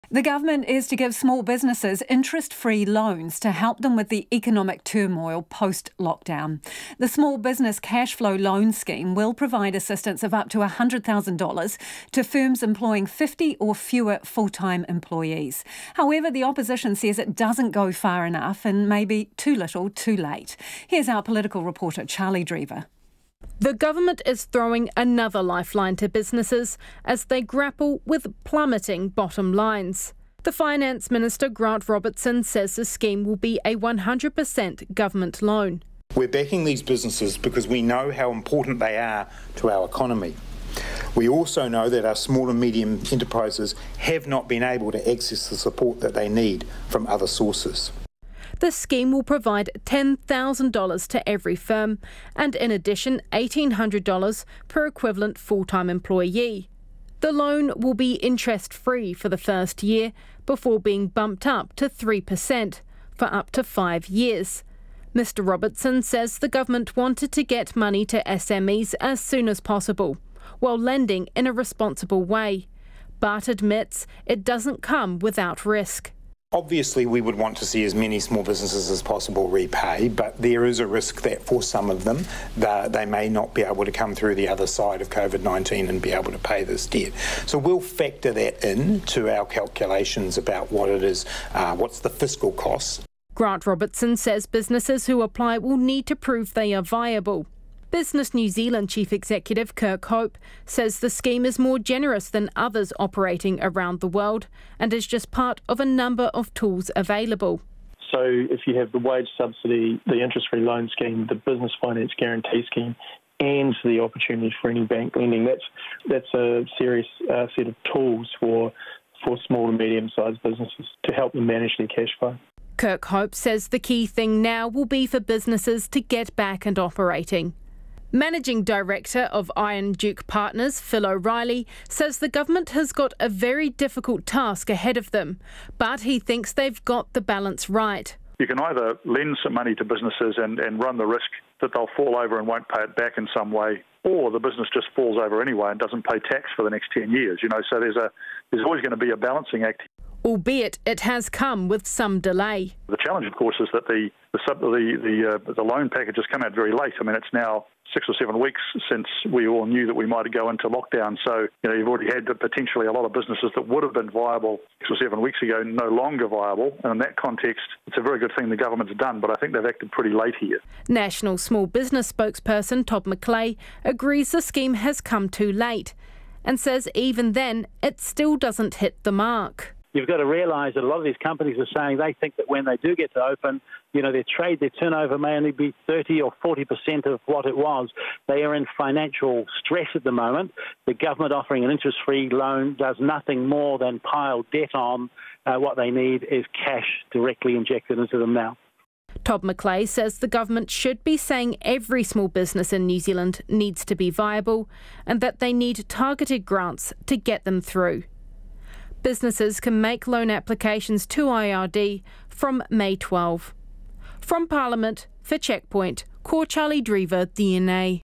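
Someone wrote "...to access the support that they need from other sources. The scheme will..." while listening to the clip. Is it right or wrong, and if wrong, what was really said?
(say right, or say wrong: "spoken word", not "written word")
right.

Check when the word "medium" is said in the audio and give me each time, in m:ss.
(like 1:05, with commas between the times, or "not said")
0:42, 1:59.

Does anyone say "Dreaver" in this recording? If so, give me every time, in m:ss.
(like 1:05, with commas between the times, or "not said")
0:22, 3:36.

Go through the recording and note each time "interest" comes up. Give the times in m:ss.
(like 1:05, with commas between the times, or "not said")
0:02, 0:58, 1:50, 3:11.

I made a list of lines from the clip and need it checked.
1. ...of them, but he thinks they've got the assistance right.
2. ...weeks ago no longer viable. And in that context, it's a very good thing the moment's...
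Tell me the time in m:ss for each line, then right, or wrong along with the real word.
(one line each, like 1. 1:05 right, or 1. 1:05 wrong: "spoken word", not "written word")
1. 2:14 wrong: "balance", not "assistance"
2. 2:45 wrong: "government", not "moment".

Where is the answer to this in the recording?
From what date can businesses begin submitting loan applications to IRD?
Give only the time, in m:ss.
3:32.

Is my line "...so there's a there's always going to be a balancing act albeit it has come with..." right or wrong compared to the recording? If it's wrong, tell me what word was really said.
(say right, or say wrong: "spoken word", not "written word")
right.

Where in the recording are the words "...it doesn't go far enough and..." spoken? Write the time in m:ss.
0:17.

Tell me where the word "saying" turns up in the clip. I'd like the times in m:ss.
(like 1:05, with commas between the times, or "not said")
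3:01, 3:21.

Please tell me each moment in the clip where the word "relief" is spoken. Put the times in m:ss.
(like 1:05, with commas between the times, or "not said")
not said.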